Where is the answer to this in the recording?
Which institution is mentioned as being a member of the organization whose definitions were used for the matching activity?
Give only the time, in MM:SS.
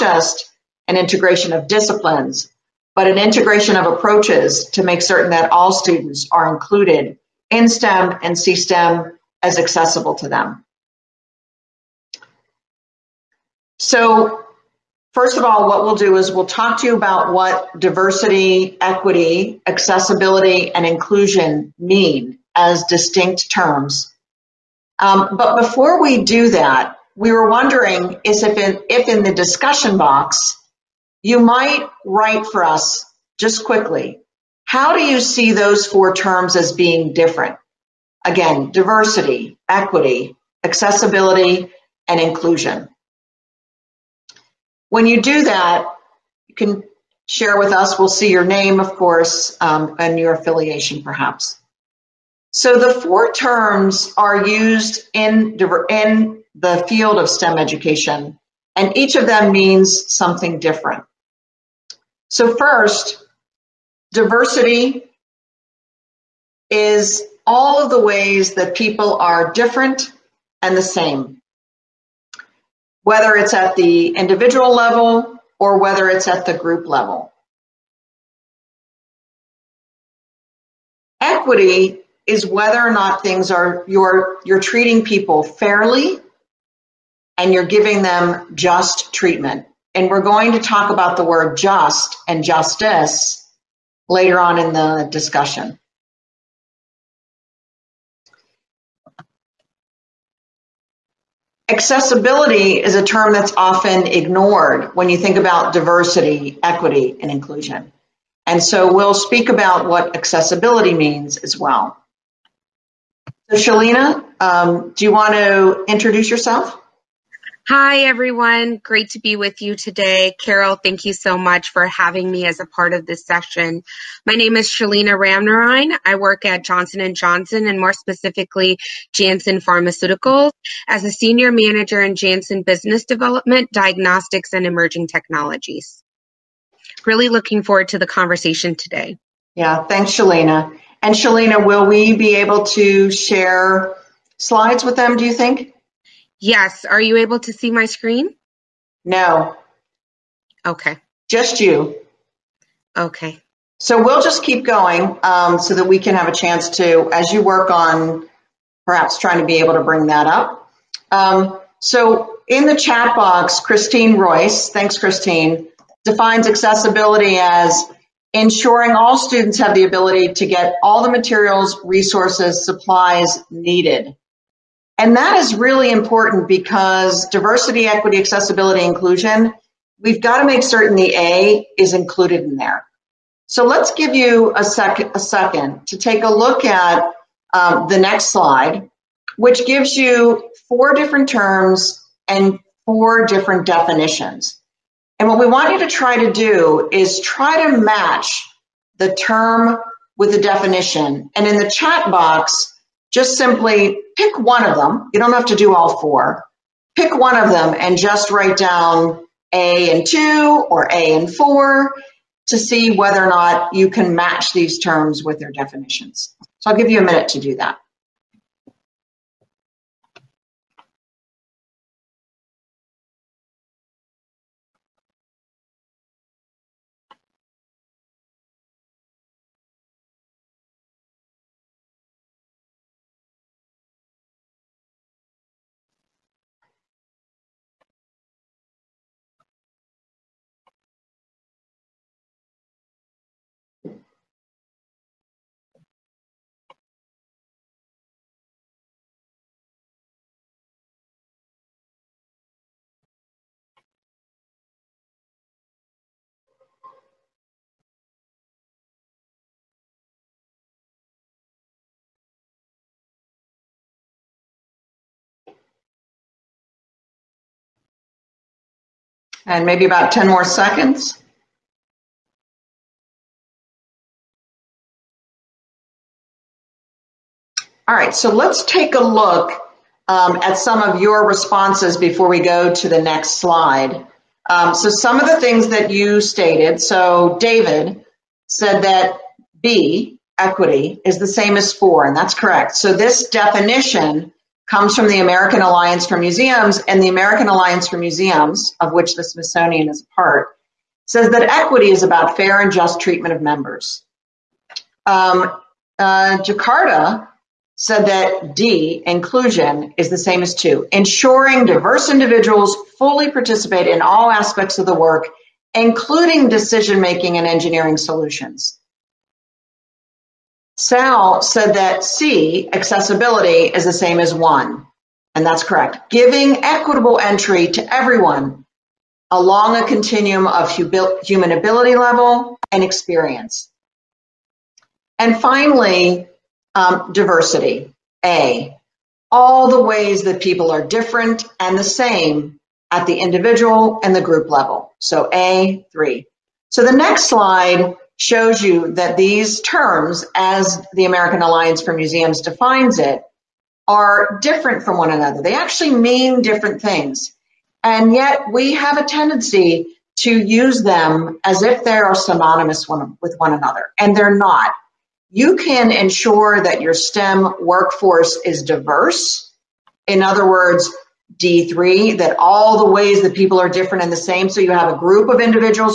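04:59.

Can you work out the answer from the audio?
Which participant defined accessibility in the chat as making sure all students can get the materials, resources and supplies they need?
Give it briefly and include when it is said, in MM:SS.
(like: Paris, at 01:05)
Christine Royce, at 02:43.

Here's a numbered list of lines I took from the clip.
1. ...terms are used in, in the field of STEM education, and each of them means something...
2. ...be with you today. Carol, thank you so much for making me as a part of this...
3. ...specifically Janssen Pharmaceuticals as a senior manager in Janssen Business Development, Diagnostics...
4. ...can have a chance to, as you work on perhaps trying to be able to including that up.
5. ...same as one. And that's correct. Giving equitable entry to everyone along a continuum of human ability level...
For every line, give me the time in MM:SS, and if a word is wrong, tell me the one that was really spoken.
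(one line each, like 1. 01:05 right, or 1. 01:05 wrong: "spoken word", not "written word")
1. 00:53 right
2. 01:59 wrong: "having", not "making"
3. 02:07 right
4. 02:35 wrong: "bring", not "including"
5. 05:23 right.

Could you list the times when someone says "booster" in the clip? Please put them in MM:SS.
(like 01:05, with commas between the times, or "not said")
not said.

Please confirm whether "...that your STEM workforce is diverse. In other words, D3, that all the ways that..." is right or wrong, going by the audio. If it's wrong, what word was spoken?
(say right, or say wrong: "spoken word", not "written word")
right.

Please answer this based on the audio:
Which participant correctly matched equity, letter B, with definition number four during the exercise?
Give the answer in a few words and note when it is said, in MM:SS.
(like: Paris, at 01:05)
David, at 04:47.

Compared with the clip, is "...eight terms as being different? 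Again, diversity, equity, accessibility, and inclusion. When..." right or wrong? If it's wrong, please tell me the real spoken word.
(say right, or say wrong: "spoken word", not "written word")
wrong: "four", not "eight".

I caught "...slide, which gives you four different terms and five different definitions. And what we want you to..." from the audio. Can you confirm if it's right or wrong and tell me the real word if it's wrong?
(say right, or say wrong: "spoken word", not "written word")
wrong: "four", not "five".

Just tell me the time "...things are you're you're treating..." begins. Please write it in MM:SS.
01:23.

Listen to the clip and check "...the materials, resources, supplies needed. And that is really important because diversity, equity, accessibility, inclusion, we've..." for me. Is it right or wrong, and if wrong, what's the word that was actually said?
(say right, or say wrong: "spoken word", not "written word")
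right.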